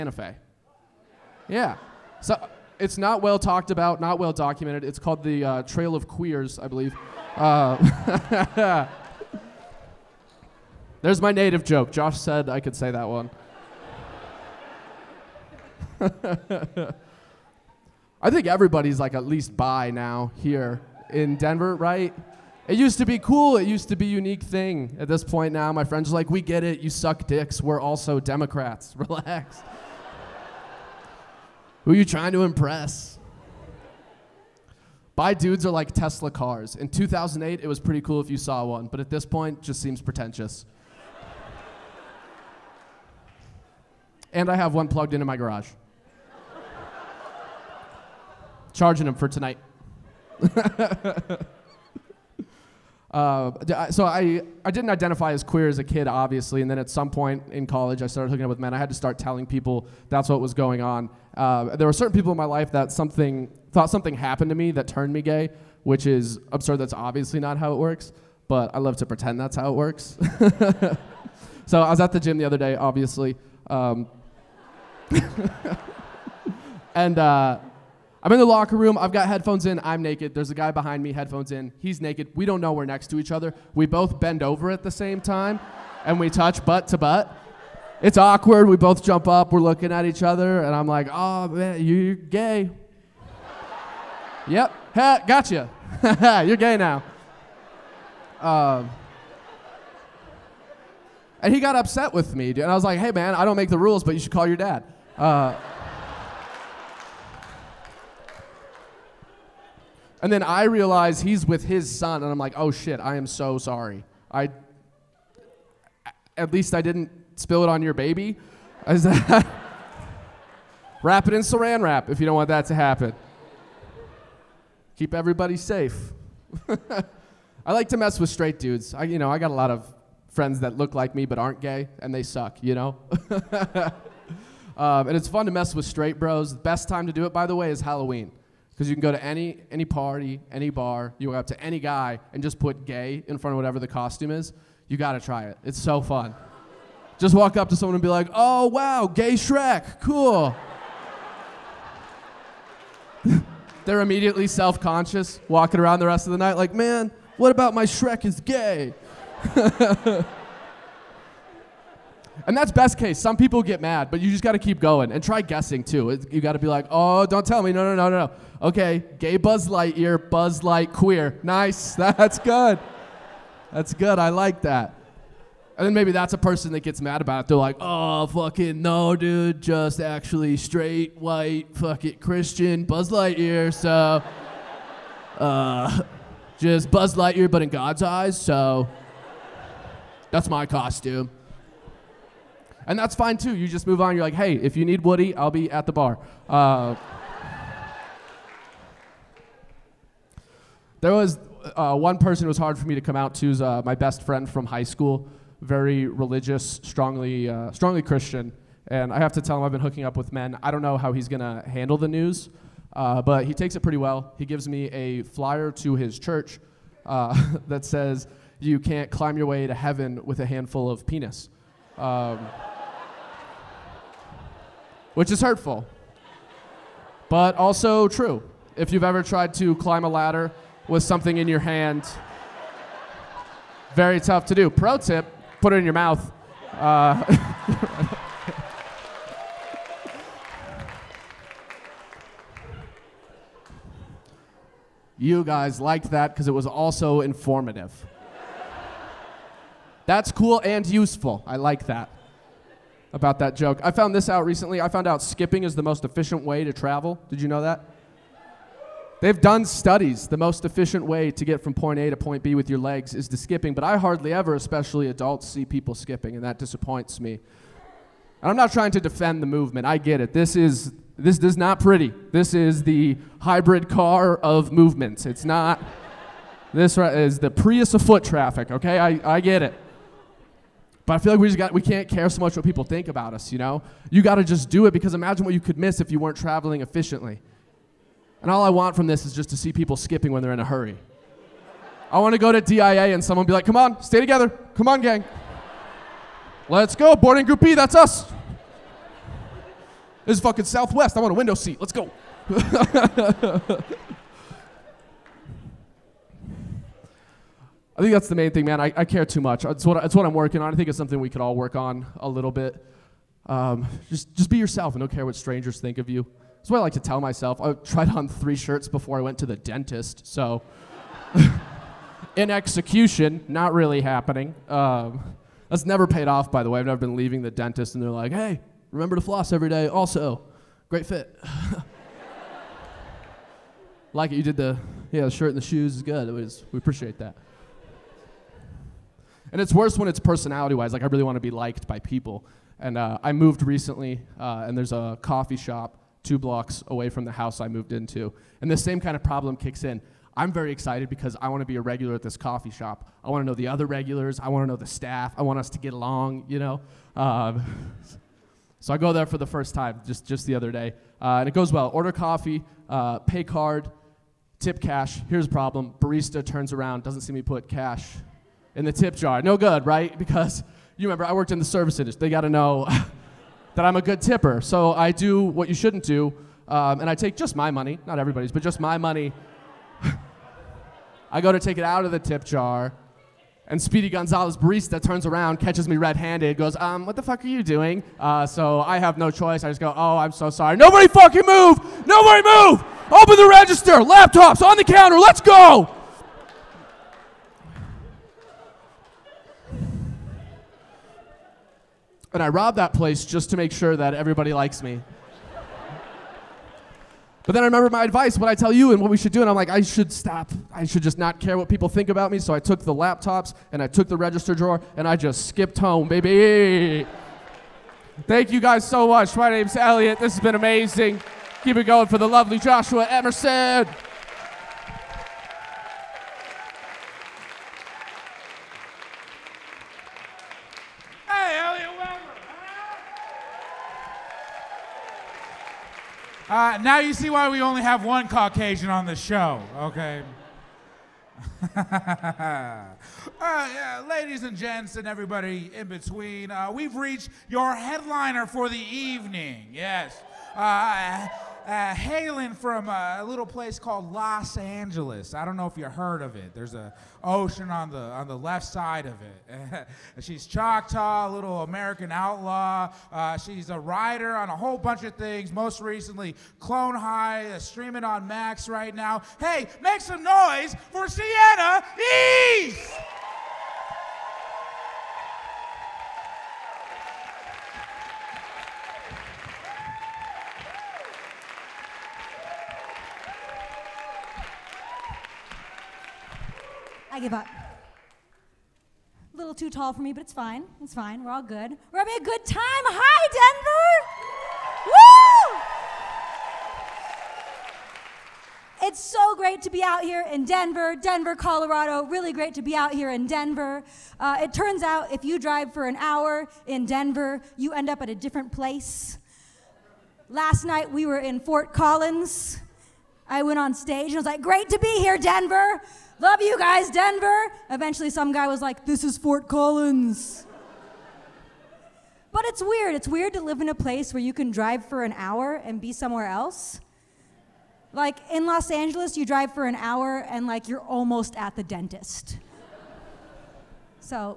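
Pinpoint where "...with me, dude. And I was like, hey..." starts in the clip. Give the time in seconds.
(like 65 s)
102 s.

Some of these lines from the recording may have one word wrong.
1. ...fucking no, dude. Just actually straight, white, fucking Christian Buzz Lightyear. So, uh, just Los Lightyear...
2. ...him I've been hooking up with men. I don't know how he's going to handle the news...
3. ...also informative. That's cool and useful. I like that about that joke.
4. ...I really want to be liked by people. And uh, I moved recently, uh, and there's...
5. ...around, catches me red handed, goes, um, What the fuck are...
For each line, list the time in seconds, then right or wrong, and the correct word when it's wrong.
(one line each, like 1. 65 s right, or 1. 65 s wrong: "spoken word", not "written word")
1. 178 s wrong: "Buzz", not "Los"
2. 209 s right
3. 246 s right
4. 341 s right
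5. 385 s right.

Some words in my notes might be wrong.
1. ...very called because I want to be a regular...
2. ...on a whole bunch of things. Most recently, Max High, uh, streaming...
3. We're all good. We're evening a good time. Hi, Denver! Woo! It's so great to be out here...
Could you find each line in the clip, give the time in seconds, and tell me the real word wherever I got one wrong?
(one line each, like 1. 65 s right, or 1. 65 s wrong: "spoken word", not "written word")
1. 350 s wrong: "excited", not "called"
2. 464 s wrong: "Clone", not "Max"
3. 491 s wrong: "having", not "evening".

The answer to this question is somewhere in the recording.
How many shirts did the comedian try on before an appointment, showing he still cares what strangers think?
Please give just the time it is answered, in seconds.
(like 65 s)
318 s.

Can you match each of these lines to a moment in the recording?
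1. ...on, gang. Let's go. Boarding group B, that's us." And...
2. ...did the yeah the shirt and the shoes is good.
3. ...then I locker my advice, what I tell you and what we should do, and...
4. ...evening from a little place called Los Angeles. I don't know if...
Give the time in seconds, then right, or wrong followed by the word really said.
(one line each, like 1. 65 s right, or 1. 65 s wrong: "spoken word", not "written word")
1. 294 s wrong: "This", not "And"
2. 334 s right
3. 407 s wrong: "remember", not "locker"
4. 451 s wrong: "hailing", not "evening".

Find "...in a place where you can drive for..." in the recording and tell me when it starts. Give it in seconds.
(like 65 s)
523 s.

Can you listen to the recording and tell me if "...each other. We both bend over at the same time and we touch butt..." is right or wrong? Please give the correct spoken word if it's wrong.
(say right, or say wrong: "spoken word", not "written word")
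right.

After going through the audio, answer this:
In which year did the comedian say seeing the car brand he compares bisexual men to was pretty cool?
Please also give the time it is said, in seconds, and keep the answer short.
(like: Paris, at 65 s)
2008, at 36 s.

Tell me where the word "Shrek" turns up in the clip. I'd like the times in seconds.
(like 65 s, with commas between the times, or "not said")
149 s, 157 s.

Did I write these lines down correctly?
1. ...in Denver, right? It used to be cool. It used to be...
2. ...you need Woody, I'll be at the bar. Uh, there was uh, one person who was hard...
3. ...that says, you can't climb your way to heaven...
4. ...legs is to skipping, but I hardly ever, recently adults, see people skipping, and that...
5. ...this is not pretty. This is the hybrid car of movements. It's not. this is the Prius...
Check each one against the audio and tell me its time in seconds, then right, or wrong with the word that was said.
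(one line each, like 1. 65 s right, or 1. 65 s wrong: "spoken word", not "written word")
1. 21 s right
2. 194 s right
3. 217 s right
4. 262 s wrong: "especially", not "recently"
5. 271 s right.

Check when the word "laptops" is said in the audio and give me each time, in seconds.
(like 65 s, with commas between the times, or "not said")
393 s, 412 s.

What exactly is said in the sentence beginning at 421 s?
Keep it going for the lovely Joshua Emerson.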